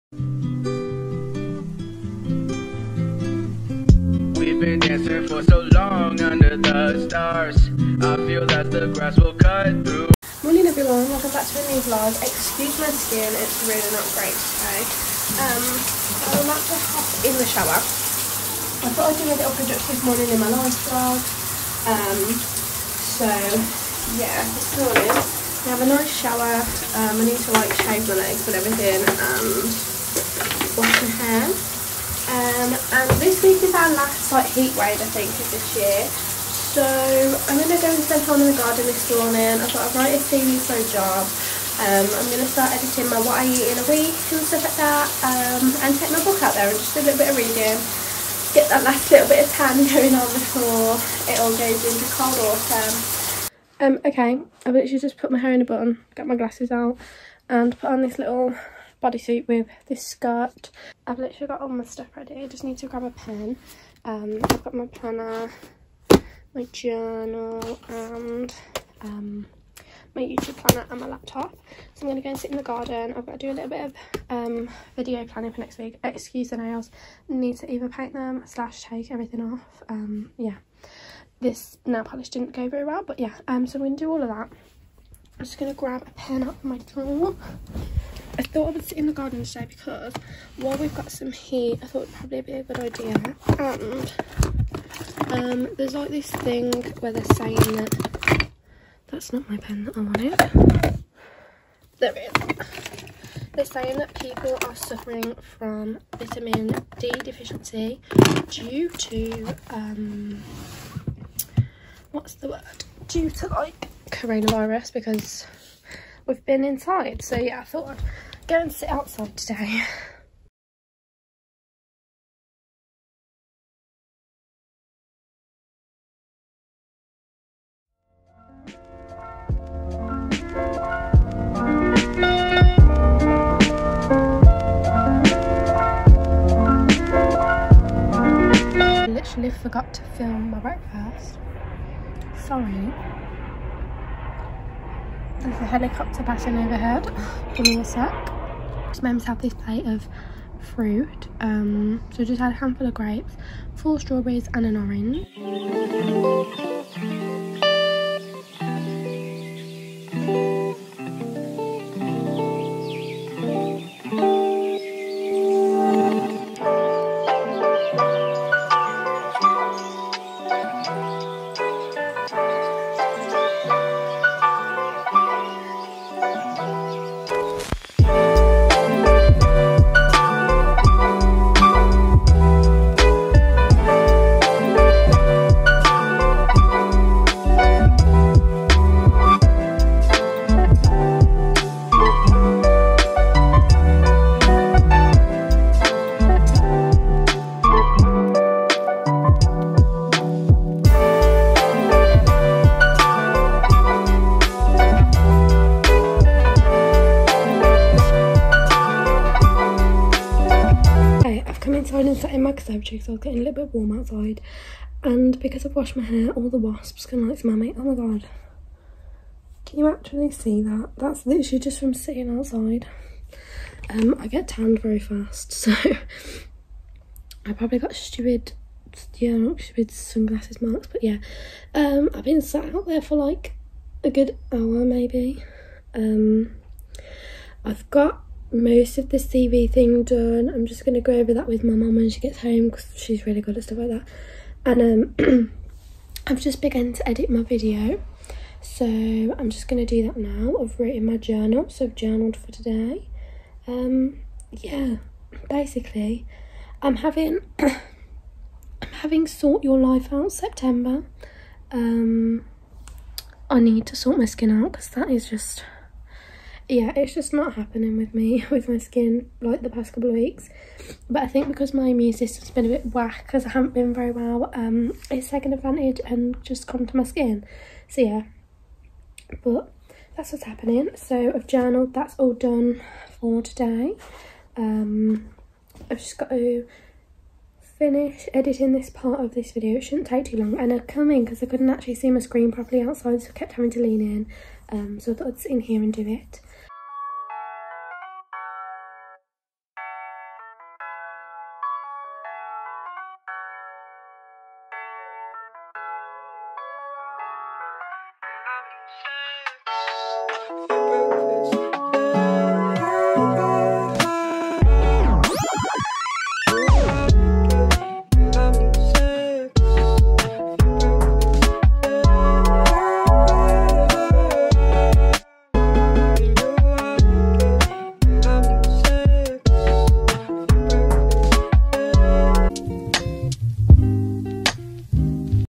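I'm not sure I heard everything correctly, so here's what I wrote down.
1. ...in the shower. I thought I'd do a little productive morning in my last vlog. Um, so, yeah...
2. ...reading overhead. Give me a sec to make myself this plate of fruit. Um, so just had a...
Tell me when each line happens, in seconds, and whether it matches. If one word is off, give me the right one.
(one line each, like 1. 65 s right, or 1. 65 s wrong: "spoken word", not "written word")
1. 17 s right
2. 146 s wrong: "passing", not "reading".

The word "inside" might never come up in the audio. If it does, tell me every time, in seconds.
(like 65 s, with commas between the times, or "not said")
116 s, 211 s.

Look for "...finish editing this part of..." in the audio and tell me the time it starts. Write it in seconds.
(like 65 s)
287 s.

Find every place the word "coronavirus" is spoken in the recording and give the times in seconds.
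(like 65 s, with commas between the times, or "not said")
114 s.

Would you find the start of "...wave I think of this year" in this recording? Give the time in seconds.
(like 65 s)
34 s.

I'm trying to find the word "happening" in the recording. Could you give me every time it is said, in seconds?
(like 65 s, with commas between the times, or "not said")
267 s, 280 s.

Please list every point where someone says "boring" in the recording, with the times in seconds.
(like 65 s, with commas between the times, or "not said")
not said.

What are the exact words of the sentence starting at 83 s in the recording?
Um, so I'm going to do all of that.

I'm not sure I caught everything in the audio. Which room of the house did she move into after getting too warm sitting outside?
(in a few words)
conservatory.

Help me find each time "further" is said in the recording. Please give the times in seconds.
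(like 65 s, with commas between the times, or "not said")
not said.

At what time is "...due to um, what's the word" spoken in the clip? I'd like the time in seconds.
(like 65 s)
108 s.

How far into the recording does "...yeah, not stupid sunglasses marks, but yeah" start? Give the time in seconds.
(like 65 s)
229 s.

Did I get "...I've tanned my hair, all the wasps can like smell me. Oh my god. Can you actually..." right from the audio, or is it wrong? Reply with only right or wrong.
wrong.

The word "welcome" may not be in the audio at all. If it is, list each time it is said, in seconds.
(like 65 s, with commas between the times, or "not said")
11 s.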